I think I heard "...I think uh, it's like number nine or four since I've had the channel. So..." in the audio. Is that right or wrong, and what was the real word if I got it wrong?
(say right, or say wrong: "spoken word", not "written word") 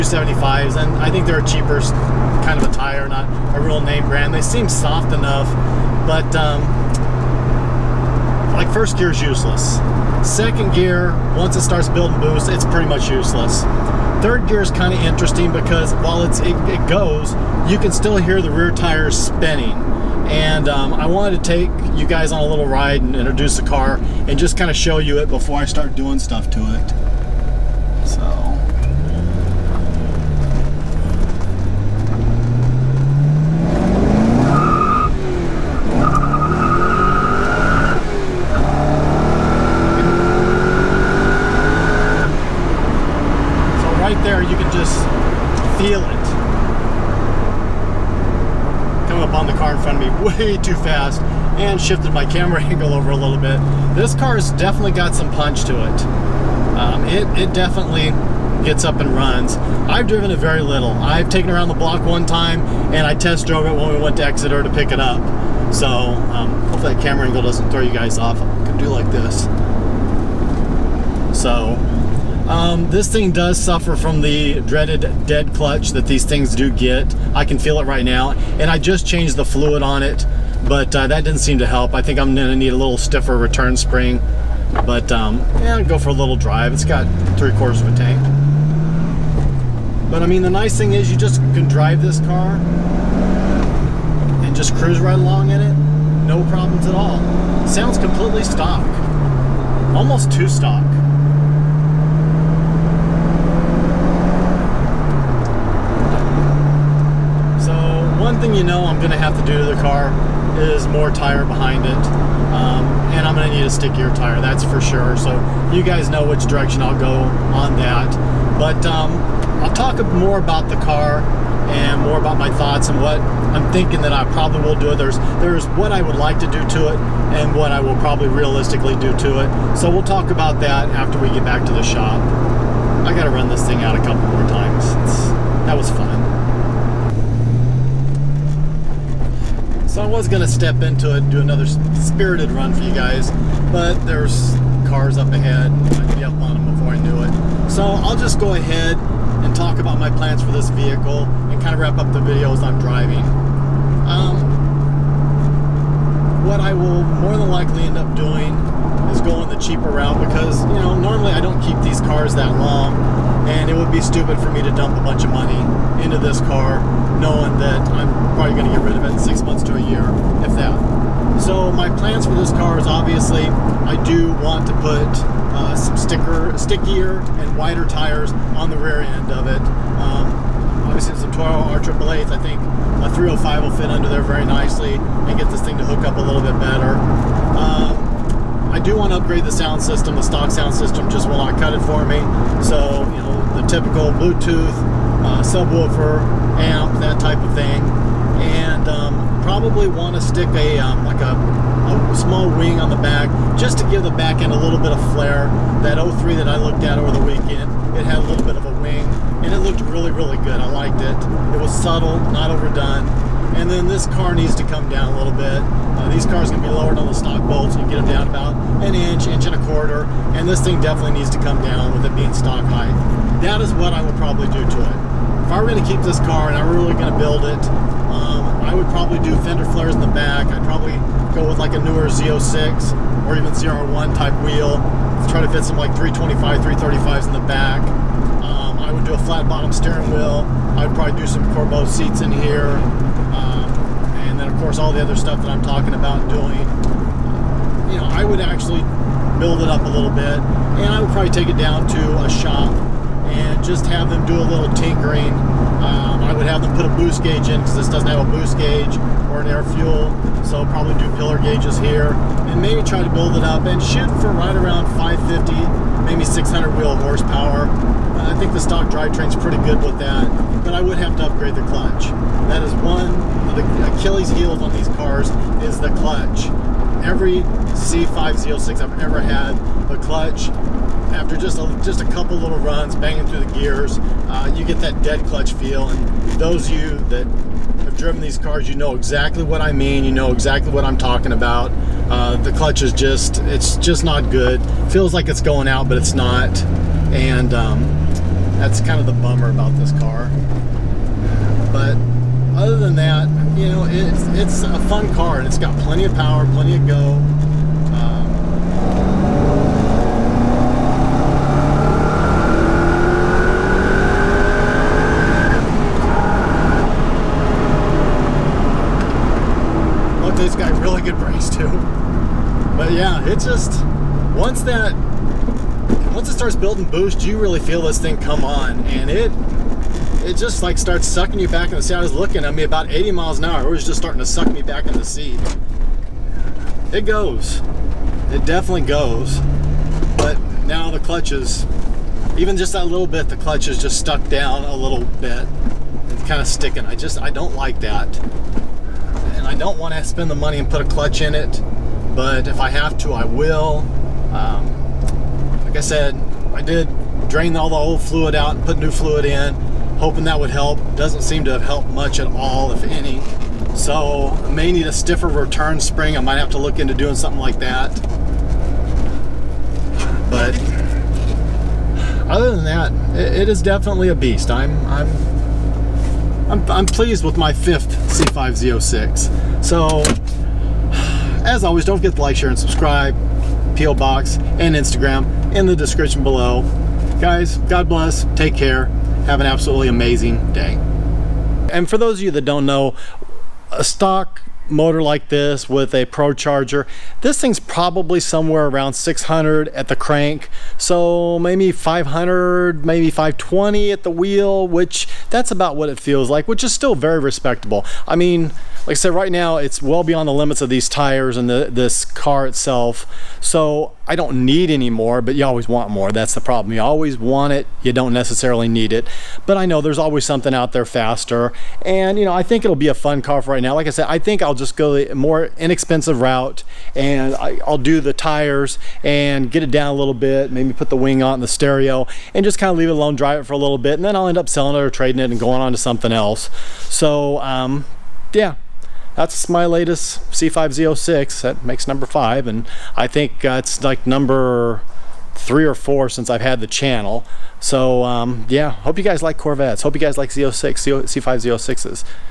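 wrong: "three", not "nine".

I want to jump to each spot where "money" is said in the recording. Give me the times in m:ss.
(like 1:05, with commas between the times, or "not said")
2:45, 5:50.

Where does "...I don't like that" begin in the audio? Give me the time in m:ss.
5:47.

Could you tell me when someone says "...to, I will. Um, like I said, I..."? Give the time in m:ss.
5:52.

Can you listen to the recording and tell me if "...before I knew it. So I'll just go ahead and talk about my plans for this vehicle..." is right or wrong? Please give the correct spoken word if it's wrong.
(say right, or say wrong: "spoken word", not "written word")
right.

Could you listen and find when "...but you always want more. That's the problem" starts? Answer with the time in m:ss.
6:55.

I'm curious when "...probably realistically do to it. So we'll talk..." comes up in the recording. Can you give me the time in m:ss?
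2:07.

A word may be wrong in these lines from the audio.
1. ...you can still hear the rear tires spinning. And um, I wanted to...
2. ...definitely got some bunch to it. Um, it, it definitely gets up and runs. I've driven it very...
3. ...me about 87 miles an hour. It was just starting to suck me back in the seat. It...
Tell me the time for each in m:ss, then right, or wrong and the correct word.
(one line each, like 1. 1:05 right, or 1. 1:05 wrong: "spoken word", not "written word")
1. 0:17 right
2. 0:54 wrong: "punch", not "bunch"
3. 5:32 wrong: "80", not "87".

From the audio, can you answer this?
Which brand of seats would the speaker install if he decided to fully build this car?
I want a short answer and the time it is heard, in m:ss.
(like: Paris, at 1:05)
Corbeau, at 4:01.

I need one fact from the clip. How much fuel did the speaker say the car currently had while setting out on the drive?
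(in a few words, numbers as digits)
Three quarters of a tank.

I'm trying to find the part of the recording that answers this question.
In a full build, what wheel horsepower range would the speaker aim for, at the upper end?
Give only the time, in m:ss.
4:26.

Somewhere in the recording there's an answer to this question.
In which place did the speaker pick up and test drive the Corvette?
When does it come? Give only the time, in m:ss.
1:04.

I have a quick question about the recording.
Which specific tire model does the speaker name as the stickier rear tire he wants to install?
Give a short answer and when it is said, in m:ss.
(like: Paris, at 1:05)
Toyo R888s, at 3:01.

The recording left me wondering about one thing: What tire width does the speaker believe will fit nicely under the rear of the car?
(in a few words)
305.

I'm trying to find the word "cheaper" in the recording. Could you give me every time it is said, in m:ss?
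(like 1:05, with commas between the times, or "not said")
0:01, 2:39.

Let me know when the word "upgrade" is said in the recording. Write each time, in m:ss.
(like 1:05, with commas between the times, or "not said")
3:09, 4:31.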